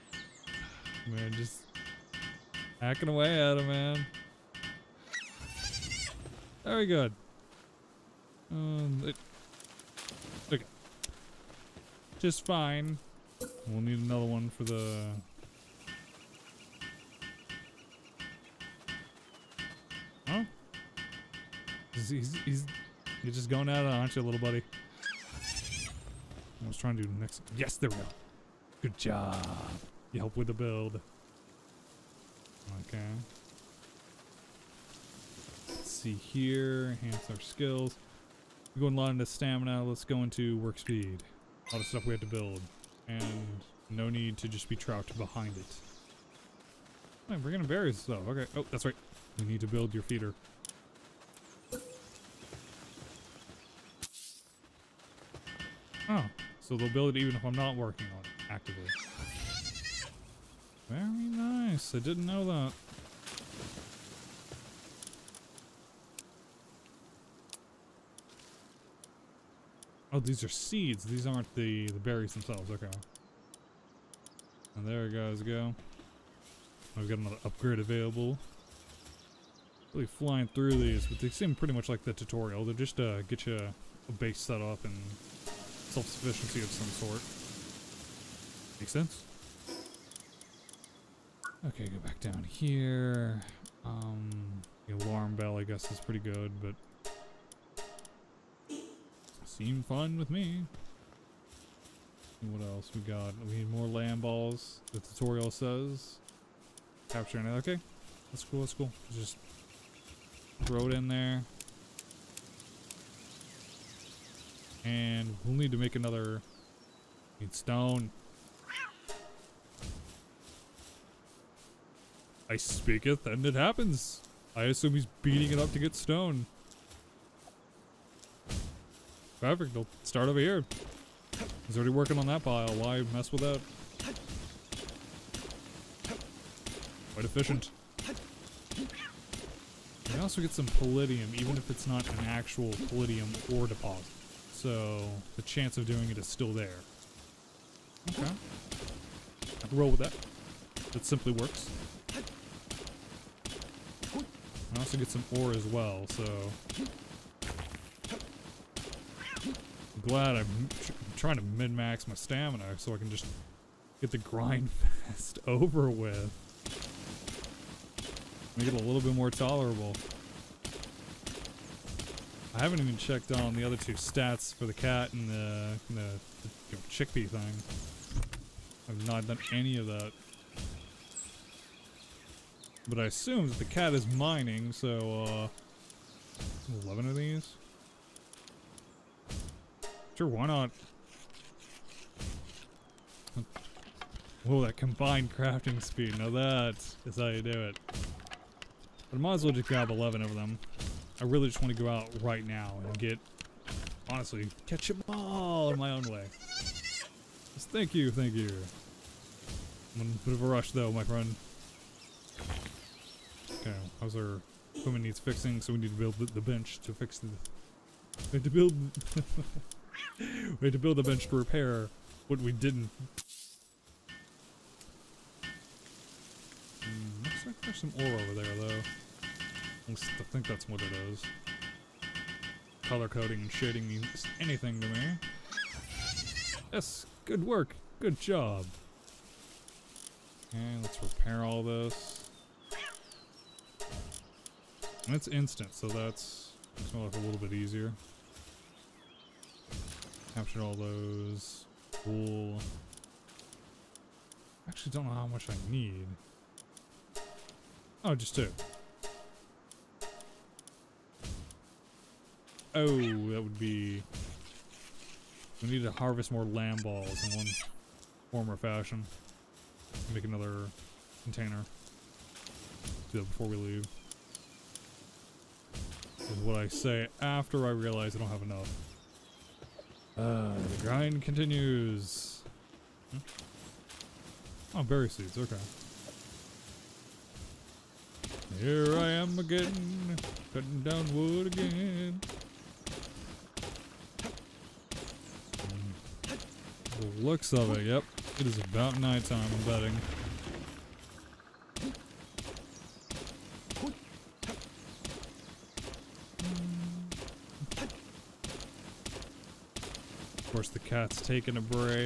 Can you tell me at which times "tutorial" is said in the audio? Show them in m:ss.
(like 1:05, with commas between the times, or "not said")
1:22, 1:44.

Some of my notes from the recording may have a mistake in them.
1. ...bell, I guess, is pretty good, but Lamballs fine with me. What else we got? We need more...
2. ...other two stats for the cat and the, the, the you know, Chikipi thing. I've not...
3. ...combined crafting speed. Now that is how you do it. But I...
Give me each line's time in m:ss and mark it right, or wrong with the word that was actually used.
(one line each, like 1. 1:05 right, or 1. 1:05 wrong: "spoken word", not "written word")
1. 1:35 wrong: "Seem", not "Lamballs"
2. 2:53 right
3. 3:14 right.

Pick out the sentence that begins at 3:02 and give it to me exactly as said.
But I assume that the cat is mining, so, uh, 11 of these?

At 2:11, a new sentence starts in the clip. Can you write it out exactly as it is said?
He's already working on that pile, why mess with that?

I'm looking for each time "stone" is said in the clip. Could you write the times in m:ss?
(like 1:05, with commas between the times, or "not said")
1:57, 2:05.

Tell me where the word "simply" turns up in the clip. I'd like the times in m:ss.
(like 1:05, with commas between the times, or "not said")
2:31.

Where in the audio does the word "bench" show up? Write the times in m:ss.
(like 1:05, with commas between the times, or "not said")
3:36, 3:41.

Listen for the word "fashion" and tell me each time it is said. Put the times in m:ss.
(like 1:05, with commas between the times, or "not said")
4:28.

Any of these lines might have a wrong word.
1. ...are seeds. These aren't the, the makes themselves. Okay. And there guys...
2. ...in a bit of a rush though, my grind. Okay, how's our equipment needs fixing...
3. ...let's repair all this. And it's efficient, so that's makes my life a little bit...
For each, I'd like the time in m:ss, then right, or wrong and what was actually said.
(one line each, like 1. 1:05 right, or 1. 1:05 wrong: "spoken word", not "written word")
1. 1:10 wrong: "berries", not "makes"
2. 3:30 wrong: "friend", not "grind"
3. 4:00 wrong: "instant", not "efficient".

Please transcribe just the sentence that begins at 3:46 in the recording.
Mm, looks like there's some ore over there, though.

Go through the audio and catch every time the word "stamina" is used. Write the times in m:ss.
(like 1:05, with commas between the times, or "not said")
0:39, 2:42.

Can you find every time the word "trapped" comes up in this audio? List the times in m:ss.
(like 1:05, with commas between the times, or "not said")
0:44.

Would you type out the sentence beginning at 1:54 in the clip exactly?
And we'll need to make another...